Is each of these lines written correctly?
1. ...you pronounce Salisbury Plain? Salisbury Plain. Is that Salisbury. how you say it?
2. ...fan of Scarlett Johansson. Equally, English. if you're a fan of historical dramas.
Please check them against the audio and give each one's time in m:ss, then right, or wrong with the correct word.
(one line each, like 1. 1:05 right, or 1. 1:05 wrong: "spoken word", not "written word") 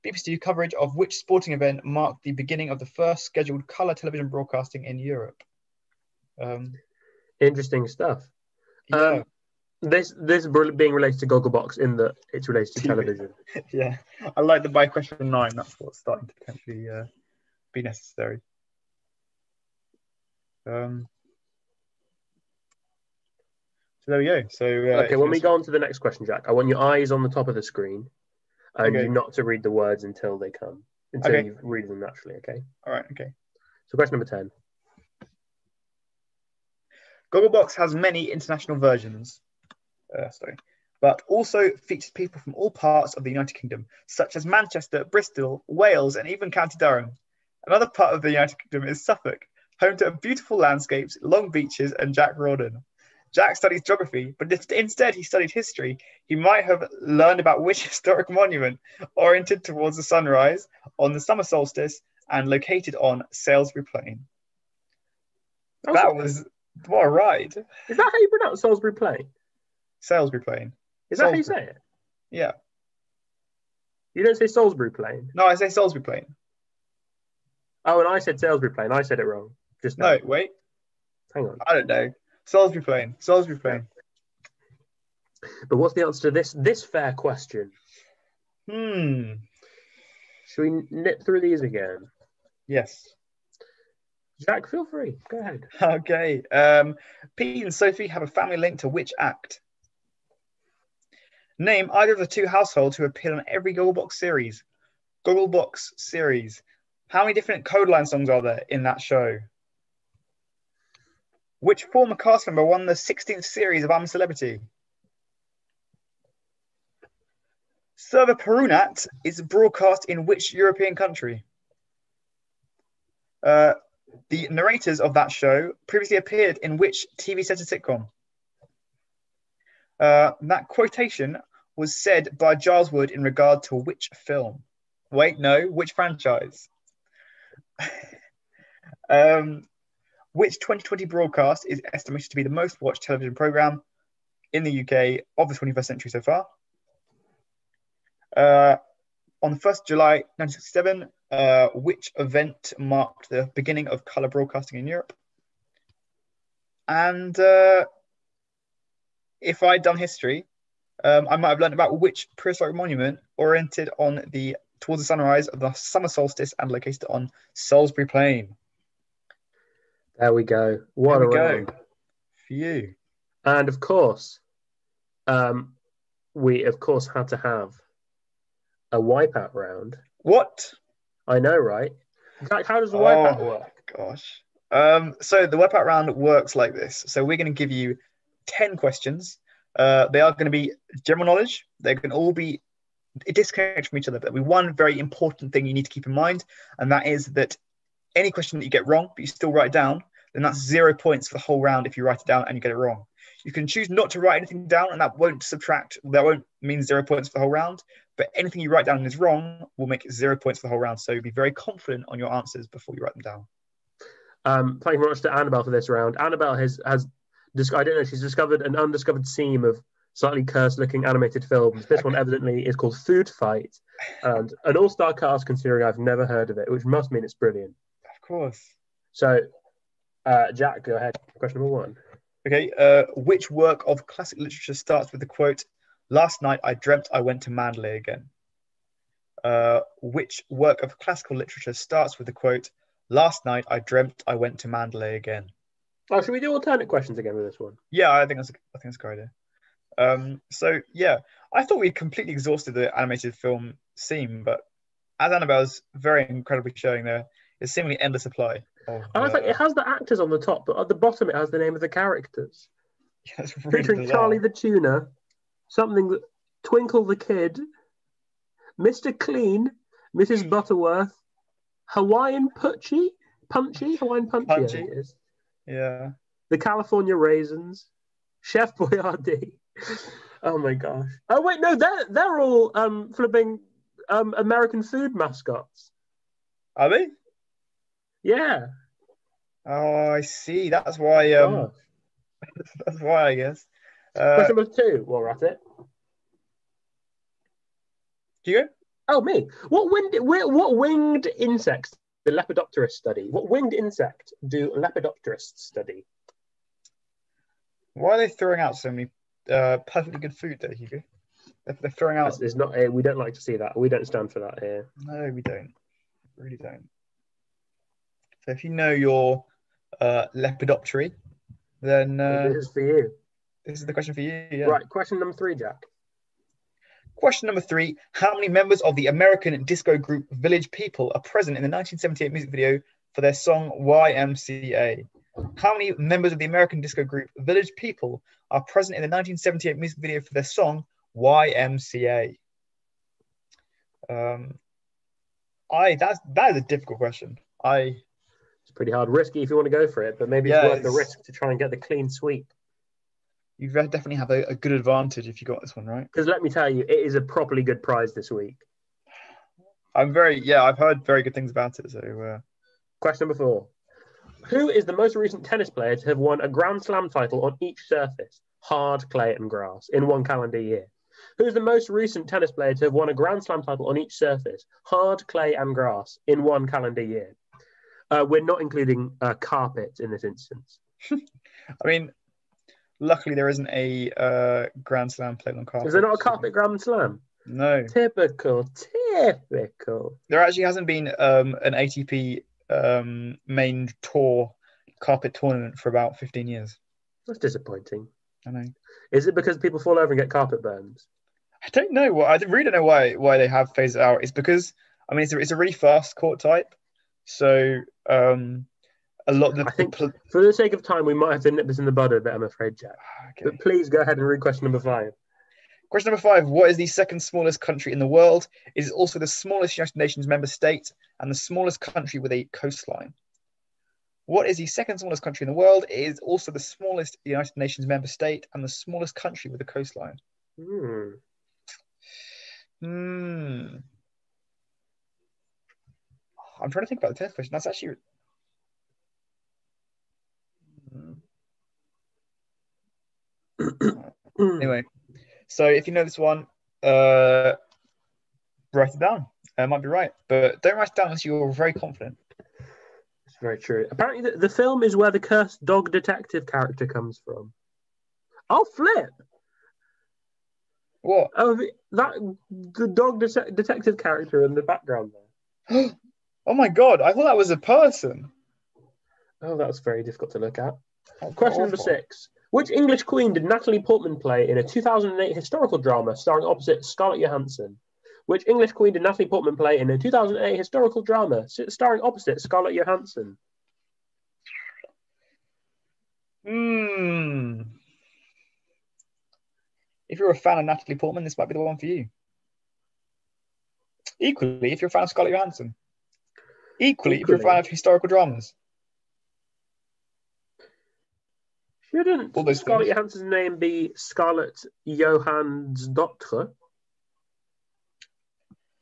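1. 1:08 right
2. 8:14 wrong: "Equally", not "English".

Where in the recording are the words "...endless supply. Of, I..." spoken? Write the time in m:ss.
4:18.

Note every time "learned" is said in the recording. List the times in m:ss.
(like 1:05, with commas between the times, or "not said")
0:57, 2:41.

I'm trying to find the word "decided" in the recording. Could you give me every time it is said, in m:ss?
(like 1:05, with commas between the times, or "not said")
not said.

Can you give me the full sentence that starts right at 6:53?
But please go ahead and read question number five.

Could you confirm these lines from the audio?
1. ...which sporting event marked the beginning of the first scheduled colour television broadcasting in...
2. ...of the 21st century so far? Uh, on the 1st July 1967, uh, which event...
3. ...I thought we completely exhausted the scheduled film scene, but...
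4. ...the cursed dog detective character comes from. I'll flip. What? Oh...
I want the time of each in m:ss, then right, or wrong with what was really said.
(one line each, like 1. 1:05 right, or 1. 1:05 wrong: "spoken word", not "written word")
1. 0:00 right
2. 2:25 right
3. 4:11 wrong: "animated", not "scheduled"
4. 7:35 right.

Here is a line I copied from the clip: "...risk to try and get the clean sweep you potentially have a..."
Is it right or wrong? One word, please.
wrong.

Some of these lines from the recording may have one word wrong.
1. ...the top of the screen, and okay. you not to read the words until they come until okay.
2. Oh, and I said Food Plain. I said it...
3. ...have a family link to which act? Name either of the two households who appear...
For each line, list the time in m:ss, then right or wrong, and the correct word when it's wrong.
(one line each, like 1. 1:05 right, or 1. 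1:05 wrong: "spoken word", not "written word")
1. 0:27 right
2. 1:17 wrong: "Salisbury", not "Food"
3. 1:38 right.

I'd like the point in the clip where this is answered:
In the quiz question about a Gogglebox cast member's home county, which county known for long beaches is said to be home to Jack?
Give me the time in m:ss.
0:49.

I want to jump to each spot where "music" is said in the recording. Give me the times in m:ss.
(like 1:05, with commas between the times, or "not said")
5:32, 5:39.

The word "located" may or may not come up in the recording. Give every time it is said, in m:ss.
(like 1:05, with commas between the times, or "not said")
1:02, 2:46.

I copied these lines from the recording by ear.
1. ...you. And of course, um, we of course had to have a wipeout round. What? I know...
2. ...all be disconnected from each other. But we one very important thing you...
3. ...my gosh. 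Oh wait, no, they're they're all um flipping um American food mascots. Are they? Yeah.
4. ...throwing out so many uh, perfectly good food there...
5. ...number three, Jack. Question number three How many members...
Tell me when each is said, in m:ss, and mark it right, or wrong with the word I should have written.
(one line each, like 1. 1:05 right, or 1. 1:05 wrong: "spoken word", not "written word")
1. 2:52 right
2. 3:12 right
3. 4:40 right
4. 5:08 right
5. 5:25 right.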